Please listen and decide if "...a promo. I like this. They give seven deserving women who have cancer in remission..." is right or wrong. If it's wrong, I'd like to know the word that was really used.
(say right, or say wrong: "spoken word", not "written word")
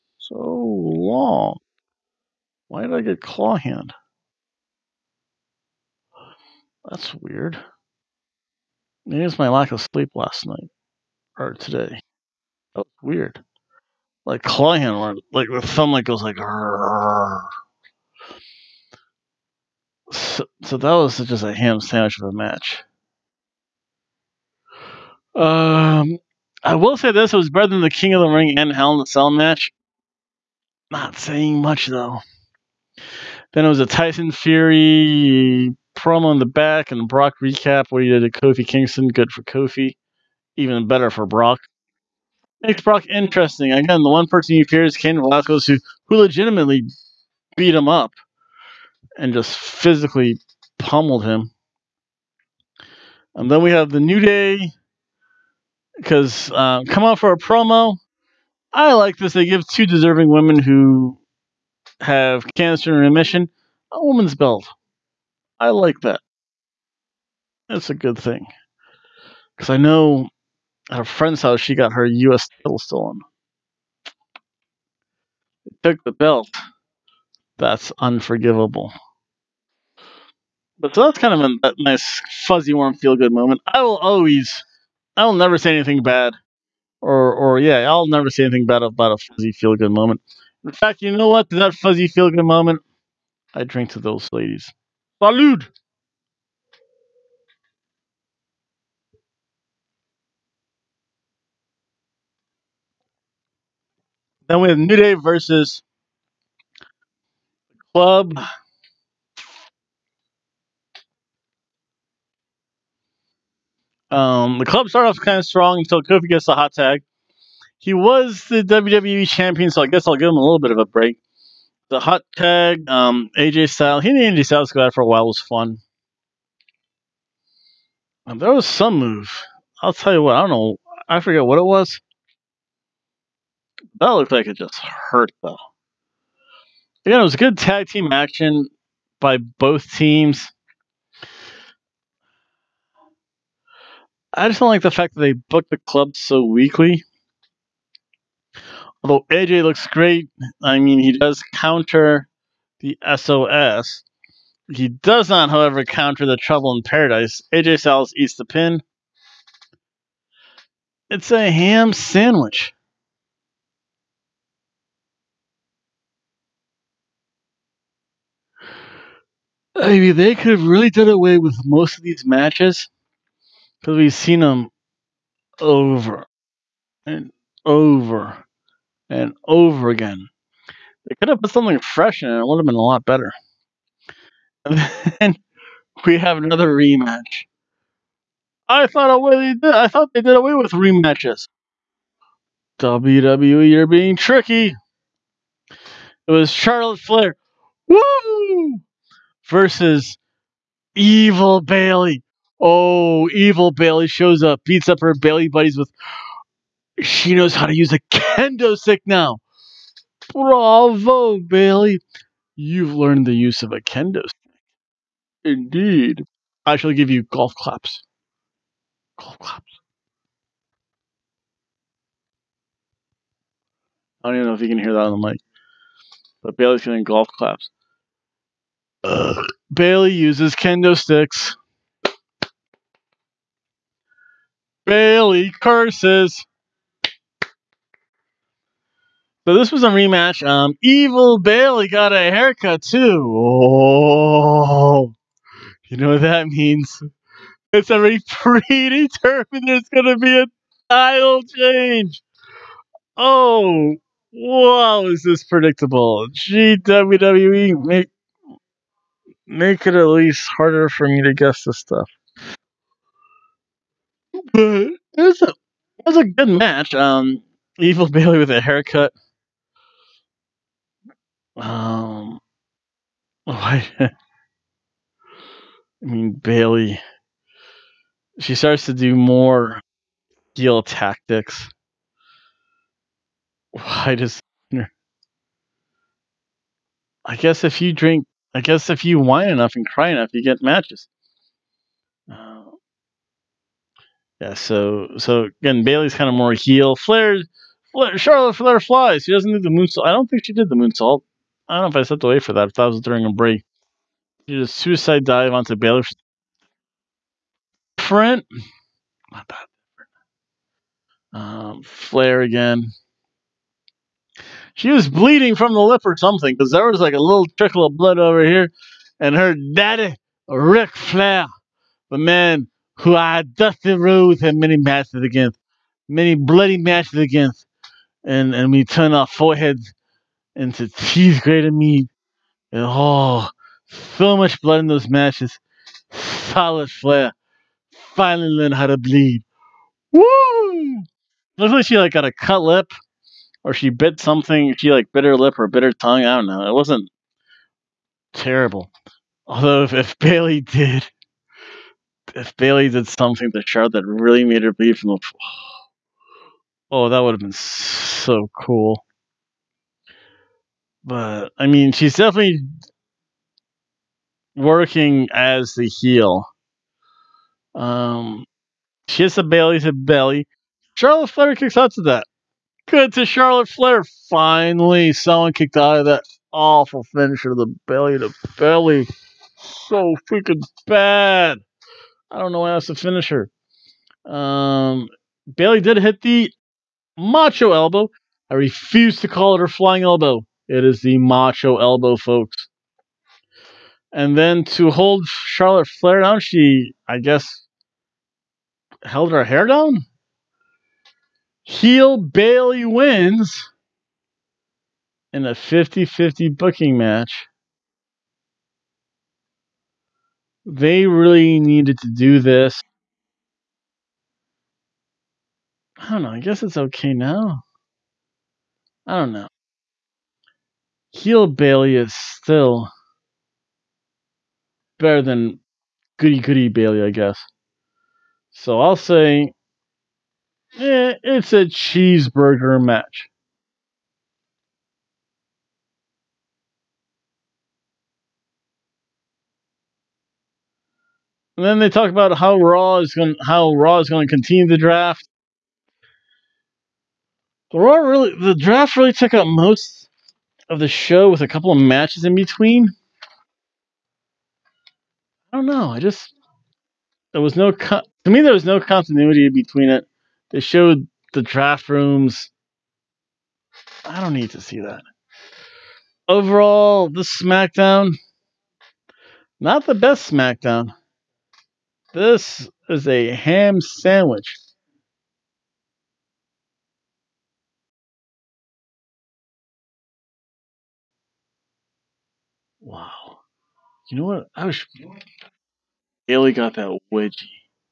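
wrong: "two", not "seven".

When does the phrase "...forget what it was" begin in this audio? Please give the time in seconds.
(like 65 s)
131 s.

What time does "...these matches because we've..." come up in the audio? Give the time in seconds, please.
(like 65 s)
172 s.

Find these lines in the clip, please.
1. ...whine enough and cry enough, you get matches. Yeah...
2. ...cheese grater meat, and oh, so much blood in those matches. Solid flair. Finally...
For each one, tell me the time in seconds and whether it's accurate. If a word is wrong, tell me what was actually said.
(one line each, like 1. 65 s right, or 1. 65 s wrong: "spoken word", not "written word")
1. 289 s right
2. 330 s right.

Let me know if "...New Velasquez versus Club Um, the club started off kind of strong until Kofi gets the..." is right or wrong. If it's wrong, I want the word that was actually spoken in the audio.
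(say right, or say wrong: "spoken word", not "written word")
wrong: "Day", not "Velasquez".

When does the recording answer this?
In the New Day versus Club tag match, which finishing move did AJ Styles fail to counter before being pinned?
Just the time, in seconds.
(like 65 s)
156 s.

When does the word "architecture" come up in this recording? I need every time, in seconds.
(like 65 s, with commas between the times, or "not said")
not said.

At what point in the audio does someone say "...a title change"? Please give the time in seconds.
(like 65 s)
250 s.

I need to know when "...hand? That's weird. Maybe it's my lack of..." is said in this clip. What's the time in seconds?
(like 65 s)
3 s.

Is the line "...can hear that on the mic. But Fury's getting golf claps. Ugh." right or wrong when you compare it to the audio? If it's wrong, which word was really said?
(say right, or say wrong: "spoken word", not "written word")
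wrong: "Bayley", not "Fury".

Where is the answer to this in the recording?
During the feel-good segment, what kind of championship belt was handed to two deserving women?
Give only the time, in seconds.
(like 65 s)
72 s.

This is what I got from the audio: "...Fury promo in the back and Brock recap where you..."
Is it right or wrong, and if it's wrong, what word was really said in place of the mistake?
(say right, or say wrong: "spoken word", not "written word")
right.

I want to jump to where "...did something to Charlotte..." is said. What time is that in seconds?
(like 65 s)
352 s.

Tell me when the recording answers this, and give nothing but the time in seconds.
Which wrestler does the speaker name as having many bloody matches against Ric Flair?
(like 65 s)
323 s.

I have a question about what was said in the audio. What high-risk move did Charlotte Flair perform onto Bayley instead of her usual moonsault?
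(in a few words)
suicide dive.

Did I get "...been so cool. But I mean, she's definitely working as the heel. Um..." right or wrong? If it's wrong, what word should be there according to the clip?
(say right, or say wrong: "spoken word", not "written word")
right.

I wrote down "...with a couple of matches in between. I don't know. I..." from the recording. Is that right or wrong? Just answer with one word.
right.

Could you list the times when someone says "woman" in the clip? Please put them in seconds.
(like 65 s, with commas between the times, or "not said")
64 s.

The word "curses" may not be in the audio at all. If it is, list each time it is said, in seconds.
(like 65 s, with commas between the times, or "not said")
235 s.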